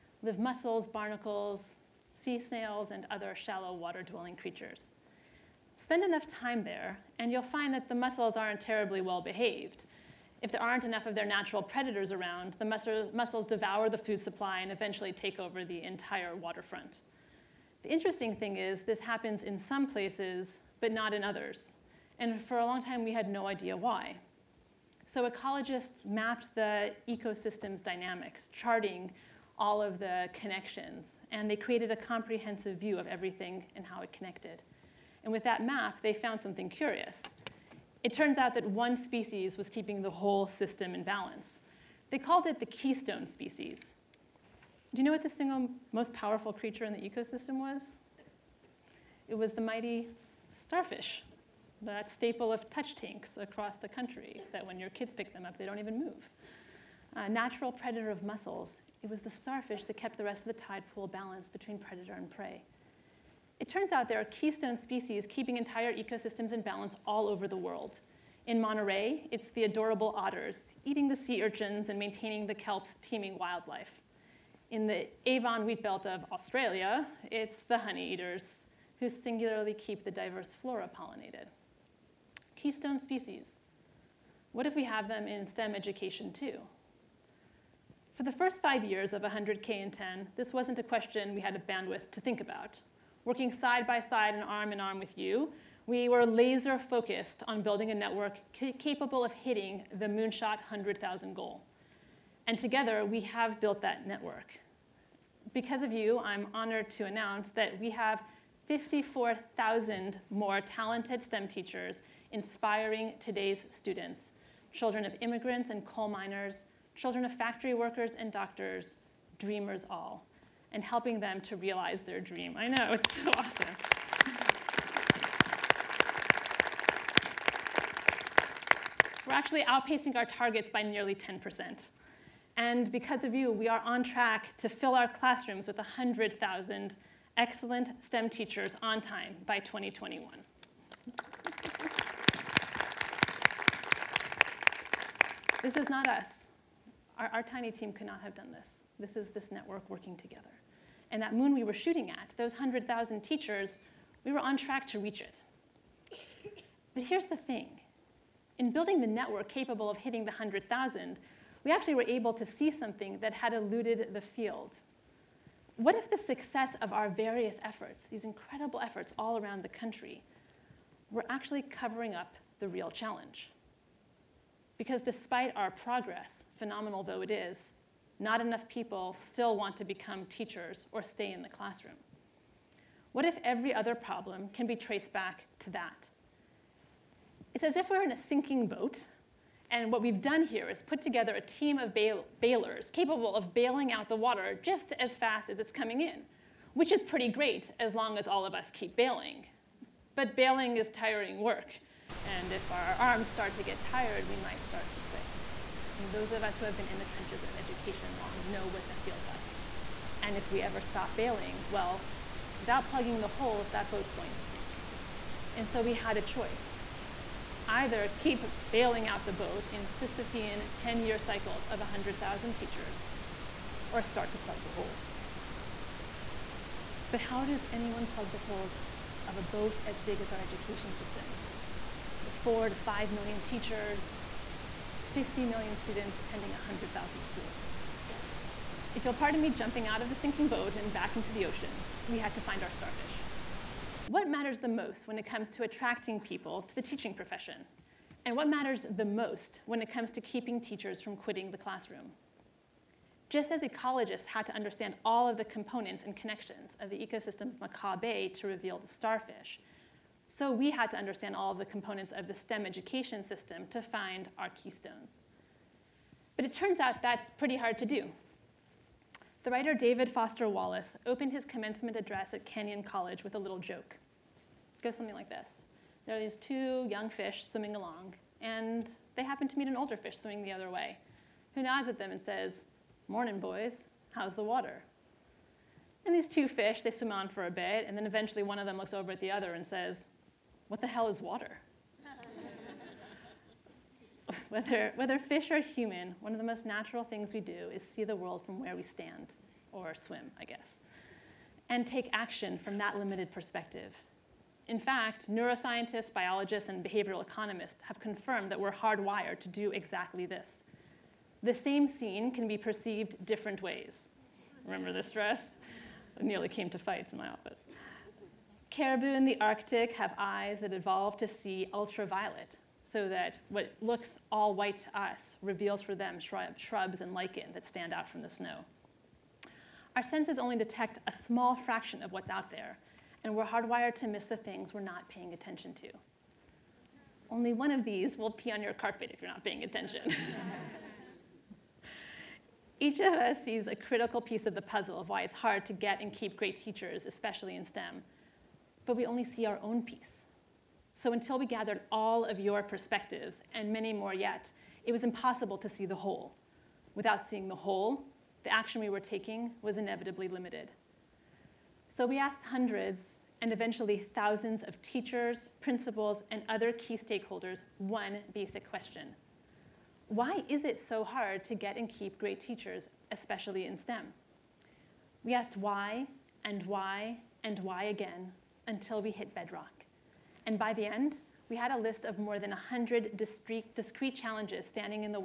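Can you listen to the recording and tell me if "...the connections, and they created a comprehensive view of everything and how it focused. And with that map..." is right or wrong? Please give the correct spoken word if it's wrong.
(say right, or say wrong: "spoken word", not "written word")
wrong: "connected", not "focused".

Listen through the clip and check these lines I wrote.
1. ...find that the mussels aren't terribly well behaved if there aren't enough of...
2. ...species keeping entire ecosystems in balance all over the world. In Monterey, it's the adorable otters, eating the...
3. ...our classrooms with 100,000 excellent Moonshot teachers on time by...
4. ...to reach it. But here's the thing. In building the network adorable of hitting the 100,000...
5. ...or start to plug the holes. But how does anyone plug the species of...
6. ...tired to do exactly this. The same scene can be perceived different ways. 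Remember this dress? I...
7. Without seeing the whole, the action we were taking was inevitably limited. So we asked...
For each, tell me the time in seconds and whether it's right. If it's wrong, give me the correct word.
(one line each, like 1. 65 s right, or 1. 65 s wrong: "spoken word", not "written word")
1. 7 s right
2. 64 s right
3. 134 s wrong: "STEM", not "Moonshot"
4. 154 s wrong: "capable", not "adorable"
5. 223 s wrong: "holes", not "species"
6. 308 s wrong: "hardwired", not "tired"
7. 356 s right.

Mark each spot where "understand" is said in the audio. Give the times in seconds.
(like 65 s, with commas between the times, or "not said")
254 s, 260 s.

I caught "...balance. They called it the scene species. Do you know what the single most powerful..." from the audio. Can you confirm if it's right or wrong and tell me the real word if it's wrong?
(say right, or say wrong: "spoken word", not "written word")
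wrong: "keystone", not "scene".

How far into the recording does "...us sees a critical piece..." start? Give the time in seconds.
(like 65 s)
343 s.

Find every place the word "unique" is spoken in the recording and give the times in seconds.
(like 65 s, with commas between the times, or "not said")
not said.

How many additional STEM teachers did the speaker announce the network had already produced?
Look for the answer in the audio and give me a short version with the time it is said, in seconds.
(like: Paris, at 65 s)
54,000, at 108 s.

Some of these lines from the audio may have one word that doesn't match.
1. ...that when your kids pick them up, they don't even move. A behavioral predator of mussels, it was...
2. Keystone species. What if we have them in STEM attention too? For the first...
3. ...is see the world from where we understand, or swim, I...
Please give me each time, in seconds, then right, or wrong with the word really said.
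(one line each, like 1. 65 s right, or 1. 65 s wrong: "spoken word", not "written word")
1. 54 s wrong: "natural", not "behavioral"
2. 82 s wrong: "education", not "attention"
3. 297 s wrong: "stand", not "understand".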